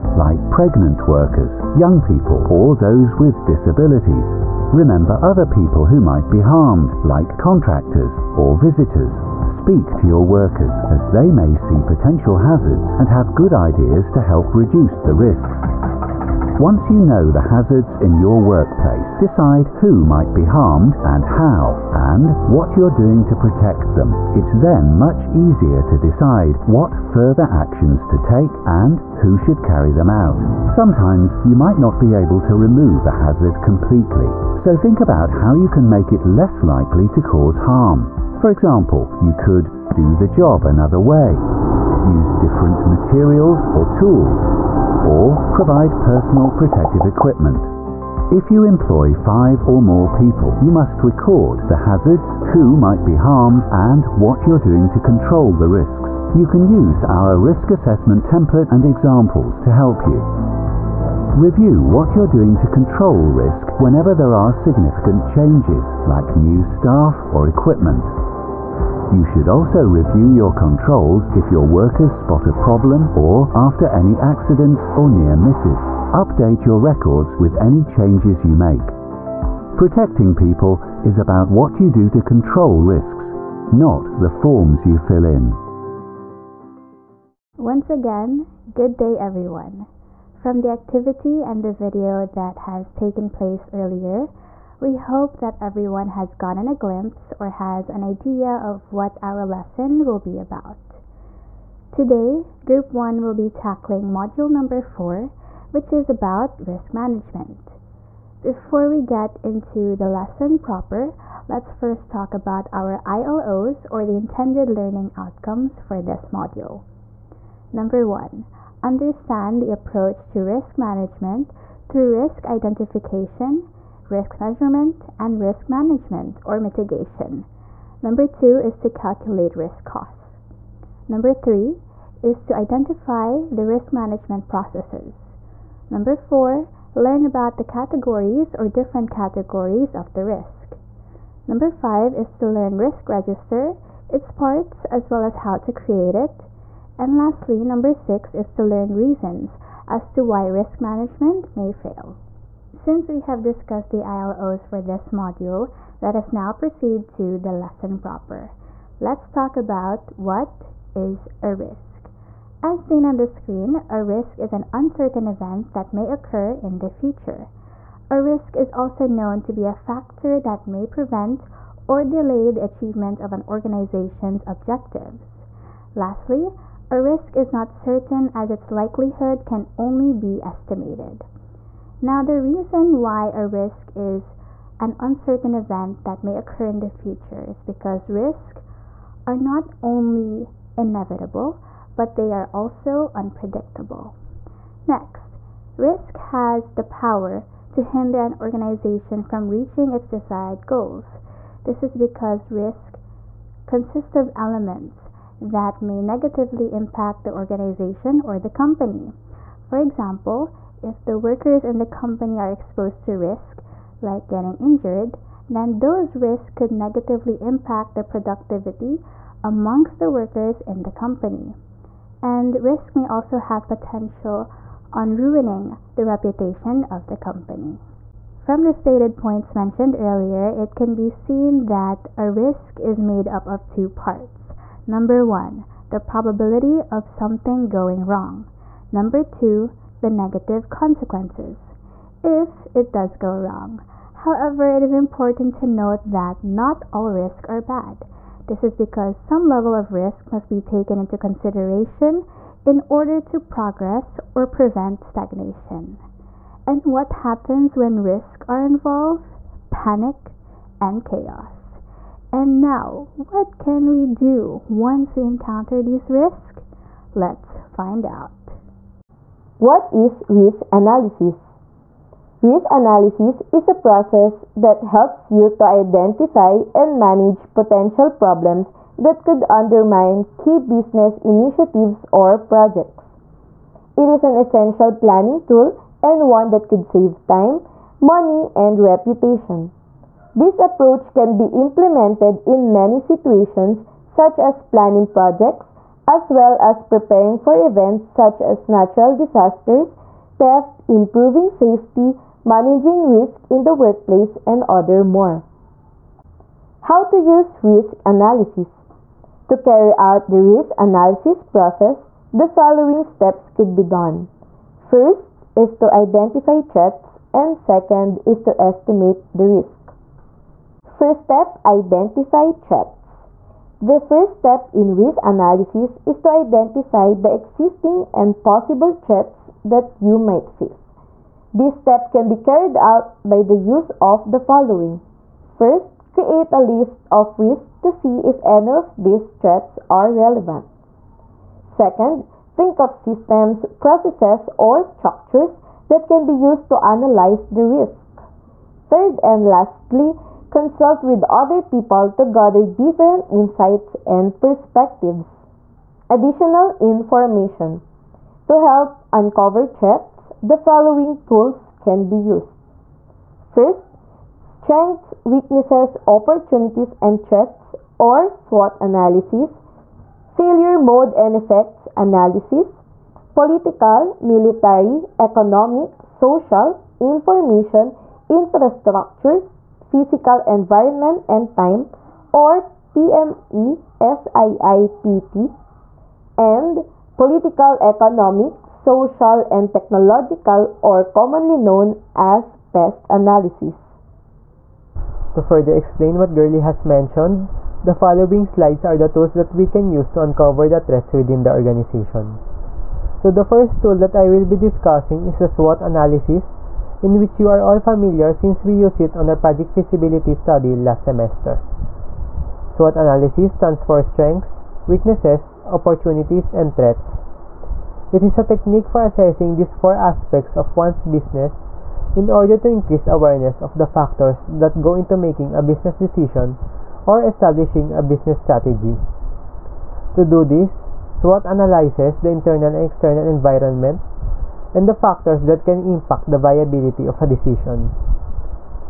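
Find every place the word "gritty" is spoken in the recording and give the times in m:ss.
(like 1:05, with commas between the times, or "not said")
not said.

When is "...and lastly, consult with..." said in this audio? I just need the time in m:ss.
5:49.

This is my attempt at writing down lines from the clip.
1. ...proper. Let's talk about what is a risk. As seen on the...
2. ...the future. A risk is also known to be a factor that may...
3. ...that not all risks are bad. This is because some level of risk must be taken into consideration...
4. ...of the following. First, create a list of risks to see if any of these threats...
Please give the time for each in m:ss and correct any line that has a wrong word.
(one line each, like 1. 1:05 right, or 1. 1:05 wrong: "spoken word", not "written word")
1. 2:37 right
2. 2:46 right
3. 4:06 right
4. 5:34 right.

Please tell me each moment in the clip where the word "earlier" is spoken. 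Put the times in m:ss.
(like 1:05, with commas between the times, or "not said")
1:33, 3:49.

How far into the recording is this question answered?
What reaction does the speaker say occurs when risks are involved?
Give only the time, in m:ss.
4:19.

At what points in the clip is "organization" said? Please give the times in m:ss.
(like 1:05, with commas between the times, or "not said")
2:53, 3:18, 3:27, 6:41.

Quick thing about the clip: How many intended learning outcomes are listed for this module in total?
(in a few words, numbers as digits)
6.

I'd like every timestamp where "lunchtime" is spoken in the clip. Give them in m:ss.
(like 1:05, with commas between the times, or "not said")
not said.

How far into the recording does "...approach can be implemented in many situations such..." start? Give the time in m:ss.
4:50.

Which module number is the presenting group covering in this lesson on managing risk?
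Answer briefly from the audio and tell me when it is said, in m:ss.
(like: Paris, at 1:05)
4, at 1:44.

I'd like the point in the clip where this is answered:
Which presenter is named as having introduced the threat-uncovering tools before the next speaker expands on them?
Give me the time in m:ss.
6:36.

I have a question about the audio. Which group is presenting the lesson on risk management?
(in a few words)
Group 1.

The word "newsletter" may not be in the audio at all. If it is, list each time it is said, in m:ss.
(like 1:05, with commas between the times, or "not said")
not said.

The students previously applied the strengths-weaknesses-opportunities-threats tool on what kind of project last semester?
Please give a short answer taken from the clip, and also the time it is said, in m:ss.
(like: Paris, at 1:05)
project feasibility study, at 6:49.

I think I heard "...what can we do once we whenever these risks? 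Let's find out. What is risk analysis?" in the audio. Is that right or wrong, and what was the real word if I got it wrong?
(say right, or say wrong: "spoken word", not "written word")
wrong: "encounter", not "whenever".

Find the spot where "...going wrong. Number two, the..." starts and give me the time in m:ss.
3:57.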